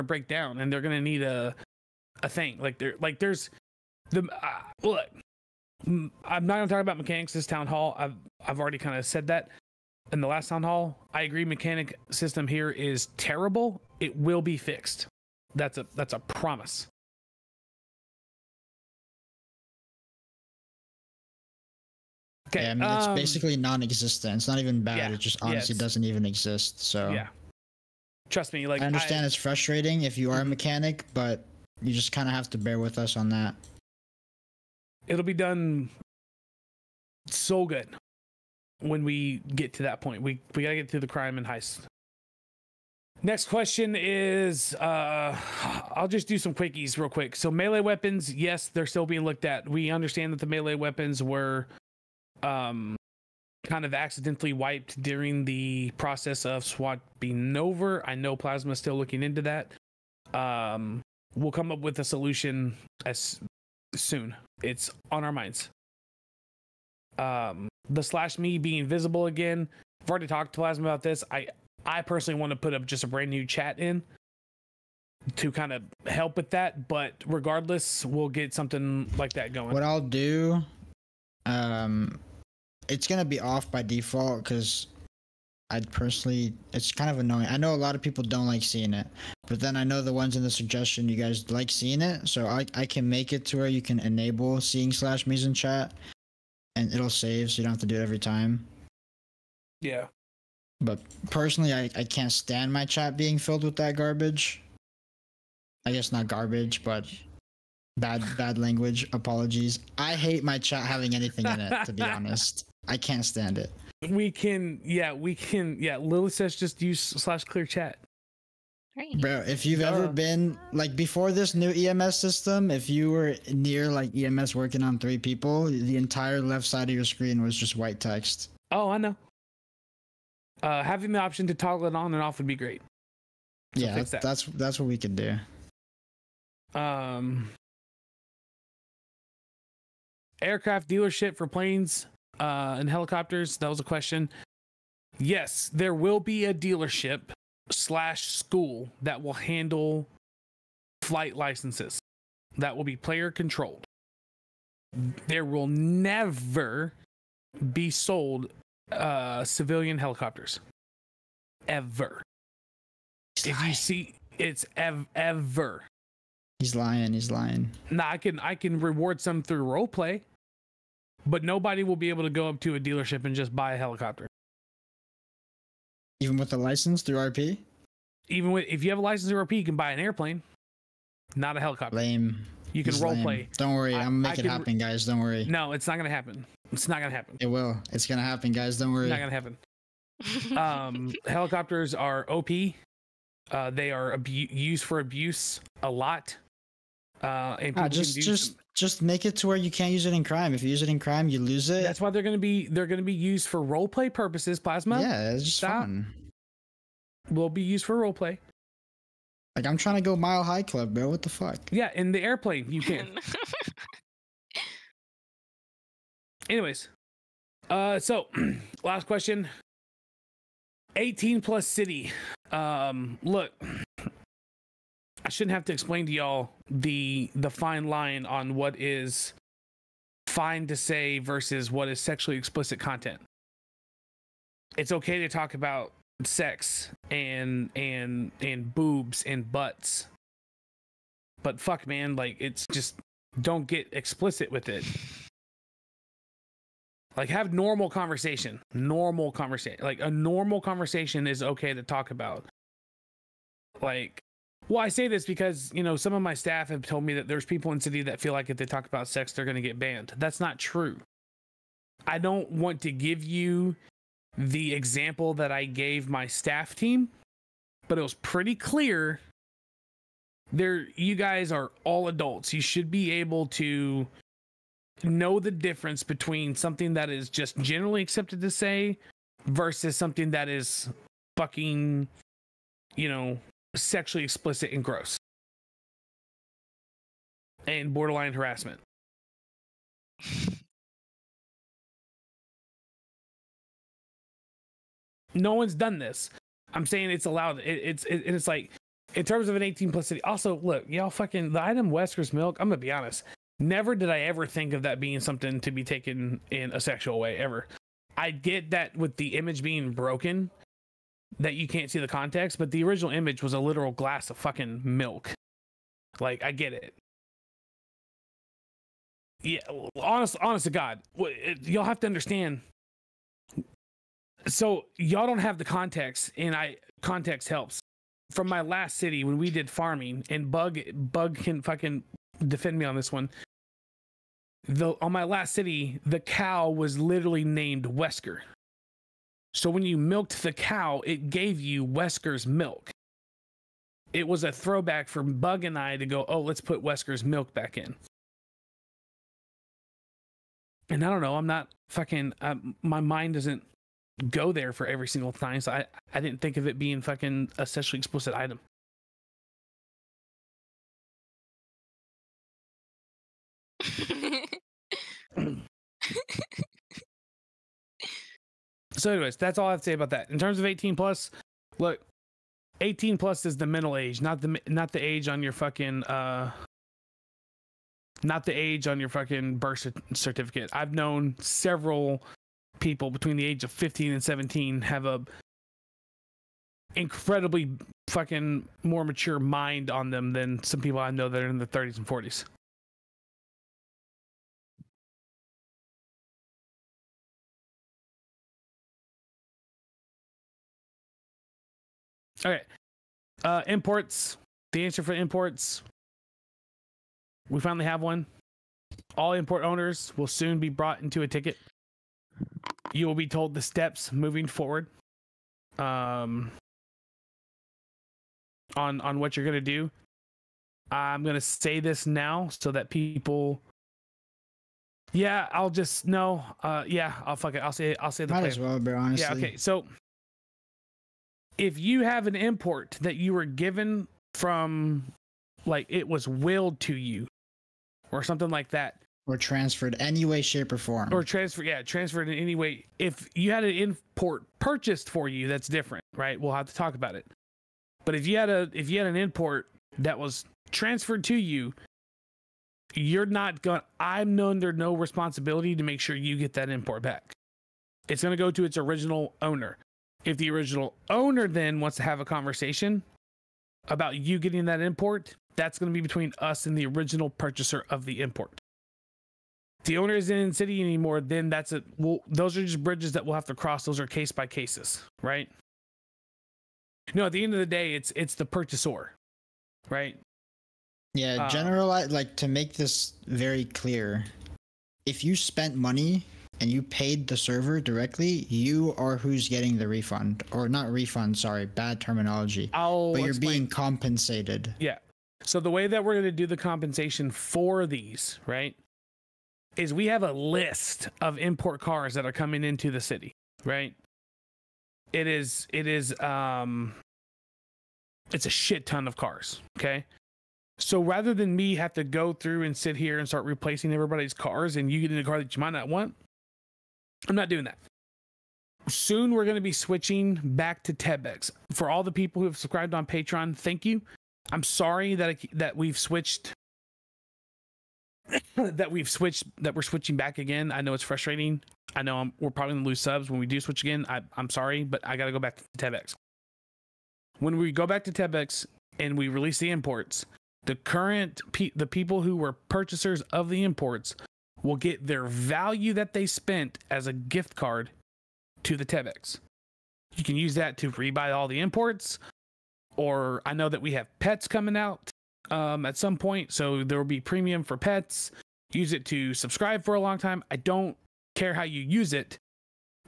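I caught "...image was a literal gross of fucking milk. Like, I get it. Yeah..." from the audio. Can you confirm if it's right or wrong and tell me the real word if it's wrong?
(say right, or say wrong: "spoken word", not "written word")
wrong: "glass", not "gross".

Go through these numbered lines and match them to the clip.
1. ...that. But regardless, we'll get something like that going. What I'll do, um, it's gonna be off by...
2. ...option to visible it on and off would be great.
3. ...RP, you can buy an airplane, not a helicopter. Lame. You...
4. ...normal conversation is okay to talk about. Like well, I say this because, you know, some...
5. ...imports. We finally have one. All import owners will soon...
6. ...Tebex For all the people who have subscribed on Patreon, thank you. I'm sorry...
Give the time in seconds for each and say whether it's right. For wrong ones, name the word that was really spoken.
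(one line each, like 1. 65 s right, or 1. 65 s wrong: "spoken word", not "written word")
1. 76 s right
2. 131 s wrong: "toggle", not "visible"
3. 179 s right
4. 250 s right
5. 405 s right
6. 520 s right.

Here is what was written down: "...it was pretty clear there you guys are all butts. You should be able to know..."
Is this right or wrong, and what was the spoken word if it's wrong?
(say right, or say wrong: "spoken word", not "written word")
wrong: "adults", not "butts".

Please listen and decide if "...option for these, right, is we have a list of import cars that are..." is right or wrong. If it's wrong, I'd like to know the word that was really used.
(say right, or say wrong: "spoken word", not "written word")
wrong: "compensation", not "option".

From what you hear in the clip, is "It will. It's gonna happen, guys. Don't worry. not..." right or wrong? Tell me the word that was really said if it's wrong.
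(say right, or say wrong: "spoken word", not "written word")
right.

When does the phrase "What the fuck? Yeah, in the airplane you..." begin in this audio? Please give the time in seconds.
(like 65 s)
211 s.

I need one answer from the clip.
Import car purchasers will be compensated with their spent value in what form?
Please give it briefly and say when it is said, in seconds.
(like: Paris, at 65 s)
Gift card, at 547 s.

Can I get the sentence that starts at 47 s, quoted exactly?
So melee weapons, yes, they're still being looked at.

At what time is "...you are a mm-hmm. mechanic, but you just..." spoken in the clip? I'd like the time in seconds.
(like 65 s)
30 s.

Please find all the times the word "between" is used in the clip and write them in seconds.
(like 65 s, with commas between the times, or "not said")
276 s, 383 s, 466 s.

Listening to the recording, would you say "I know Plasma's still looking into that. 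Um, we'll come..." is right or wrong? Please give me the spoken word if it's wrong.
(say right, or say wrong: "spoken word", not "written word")
right.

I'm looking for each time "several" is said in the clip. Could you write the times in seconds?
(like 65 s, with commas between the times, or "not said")
381 s.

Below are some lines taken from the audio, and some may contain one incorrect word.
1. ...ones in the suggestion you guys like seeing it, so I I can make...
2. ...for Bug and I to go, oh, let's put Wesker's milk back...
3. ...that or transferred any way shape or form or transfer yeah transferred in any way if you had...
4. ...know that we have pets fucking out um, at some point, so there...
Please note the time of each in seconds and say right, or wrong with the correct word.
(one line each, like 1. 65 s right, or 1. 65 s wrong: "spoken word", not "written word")
1. 90 s right
2. 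345 s right
3. 438 s right
4. 553 s wrong: "coming", not "fucking".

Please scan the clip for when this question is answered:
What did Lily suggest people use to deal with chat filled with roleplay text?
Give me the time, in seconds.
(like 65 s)
117 s.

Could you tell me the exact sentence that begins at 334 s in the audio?
The on my last city, the cow was literally named Wesker.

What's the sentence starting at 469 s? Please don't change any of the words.
the owner isn't in city anymore, then that's it.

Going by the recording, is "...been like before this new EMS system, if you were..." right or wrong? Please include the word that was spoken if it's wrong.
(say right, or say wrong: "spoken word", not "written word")
right.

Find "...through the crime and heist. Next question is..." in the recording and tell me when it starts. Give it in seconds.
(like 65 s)
40 s.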